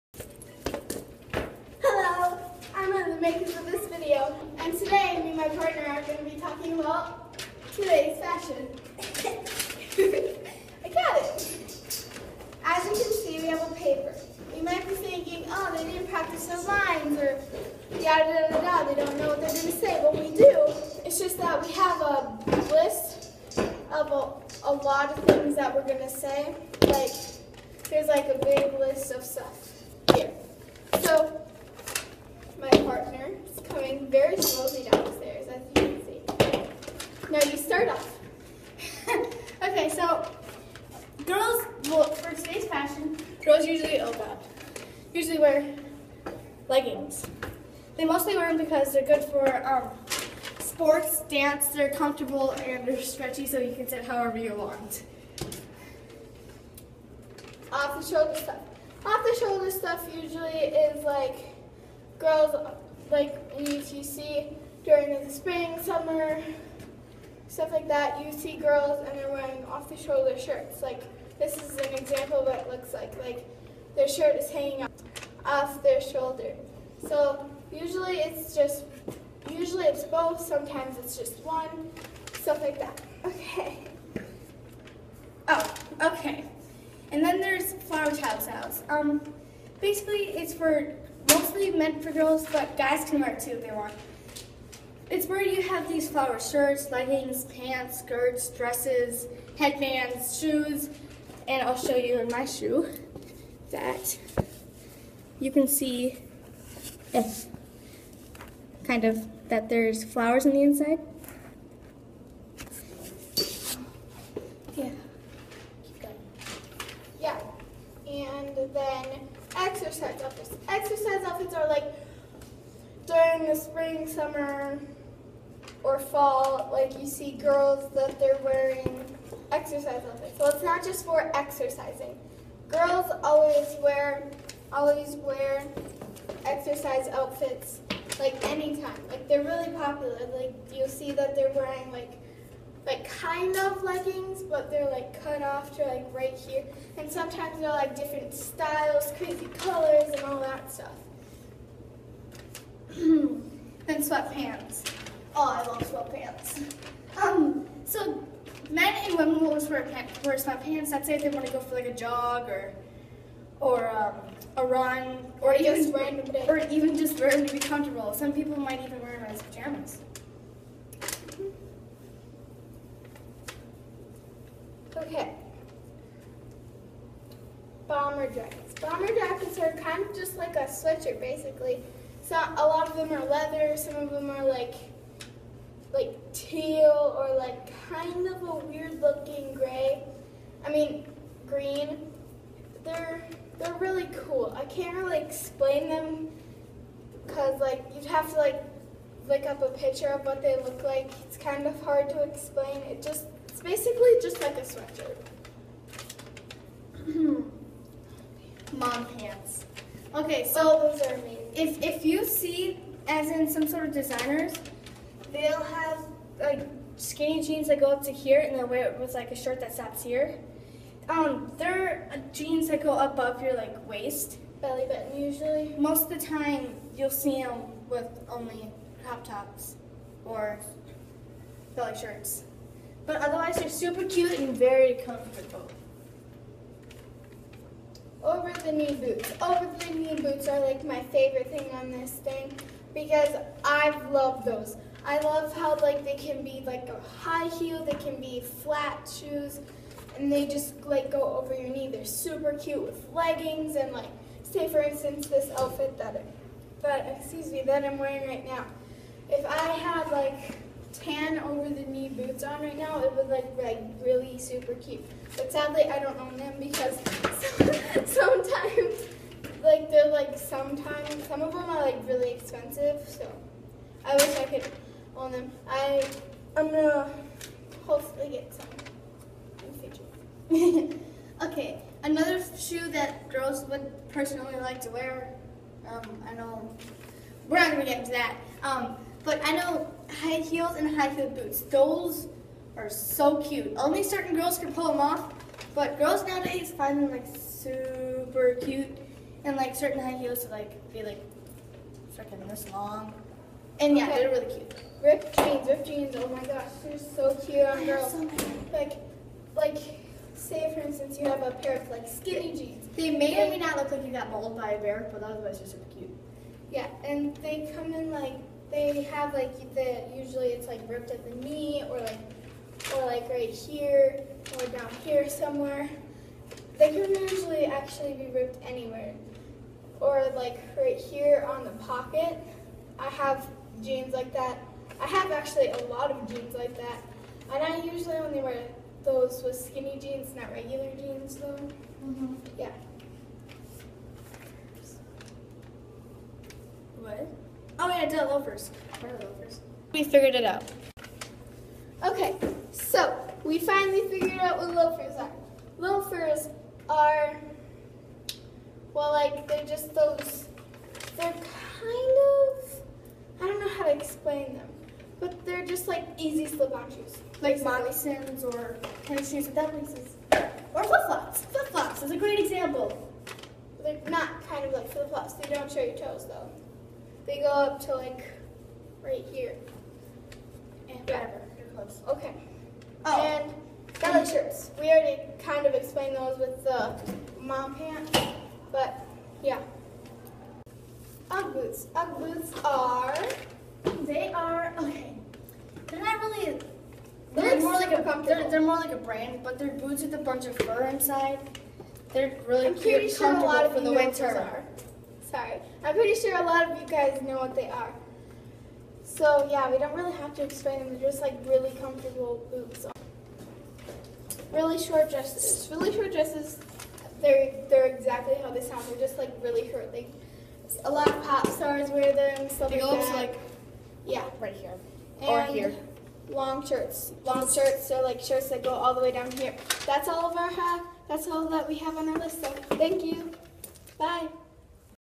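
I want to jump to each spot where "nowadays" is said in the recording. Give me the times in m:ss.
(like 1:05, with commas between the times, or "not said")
4:56.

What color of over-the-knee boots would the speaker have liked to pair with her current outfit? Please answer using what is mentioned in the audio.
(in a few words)
tan.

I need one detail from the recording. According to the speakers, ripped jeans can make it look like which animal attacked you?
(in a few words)
a bear.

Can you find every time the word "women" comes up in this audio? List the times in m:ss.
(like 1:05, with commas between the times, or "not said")
2:39.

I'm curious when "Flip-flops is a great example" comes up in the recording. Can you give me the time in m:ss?
6:11.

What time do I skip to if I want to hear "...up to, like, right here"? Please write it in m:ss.
6:17.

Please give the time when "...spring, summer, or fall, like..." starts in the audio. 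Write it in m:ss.
2:03.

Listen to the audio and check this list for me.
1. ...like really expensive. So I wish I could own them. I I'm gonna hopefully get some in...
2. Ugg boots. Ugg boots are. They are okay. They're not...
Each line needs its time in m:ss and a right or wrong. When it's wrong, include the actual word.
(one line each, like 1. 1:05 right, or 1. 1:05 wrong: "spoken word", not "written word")
1. 4:31 right
2. 6:31 right.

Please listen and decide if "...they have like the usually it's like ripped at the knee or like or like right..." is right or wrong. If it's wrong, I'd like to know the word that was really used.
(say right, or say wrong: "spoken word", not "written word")
right.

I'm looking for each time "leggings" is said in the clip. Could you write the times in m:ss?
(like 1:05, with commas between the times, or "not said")
0:46, 1:36, 2:23, 4:13.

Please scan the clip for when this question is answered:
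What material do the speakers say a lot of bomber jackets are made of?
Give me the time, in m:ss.
3:02.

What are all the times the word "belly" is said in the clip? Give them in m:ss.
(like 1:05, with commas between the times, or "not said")
3:44, 3:51, 6:24.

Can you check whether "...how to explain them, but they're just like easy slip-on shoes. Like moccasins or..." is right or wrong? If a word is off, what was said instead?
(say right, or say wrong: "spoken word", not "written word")
right.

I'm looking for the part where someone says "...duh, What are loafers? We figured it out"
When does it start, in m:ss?
5:48.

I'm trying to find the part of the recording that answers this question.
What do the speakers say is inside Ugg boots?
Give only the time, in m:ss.
6:40.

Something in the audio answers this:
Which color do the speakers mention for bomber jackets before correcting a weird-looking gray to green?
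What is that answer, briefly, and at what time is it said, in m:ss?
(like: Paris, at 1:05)
teal, at 3:05.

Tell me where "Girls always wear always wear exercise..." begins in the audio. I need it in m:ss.
2:12.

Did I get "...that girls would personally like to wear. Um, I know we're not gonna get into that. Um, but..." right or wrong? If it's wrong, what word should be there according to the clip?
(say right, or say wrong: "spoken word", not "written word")
right.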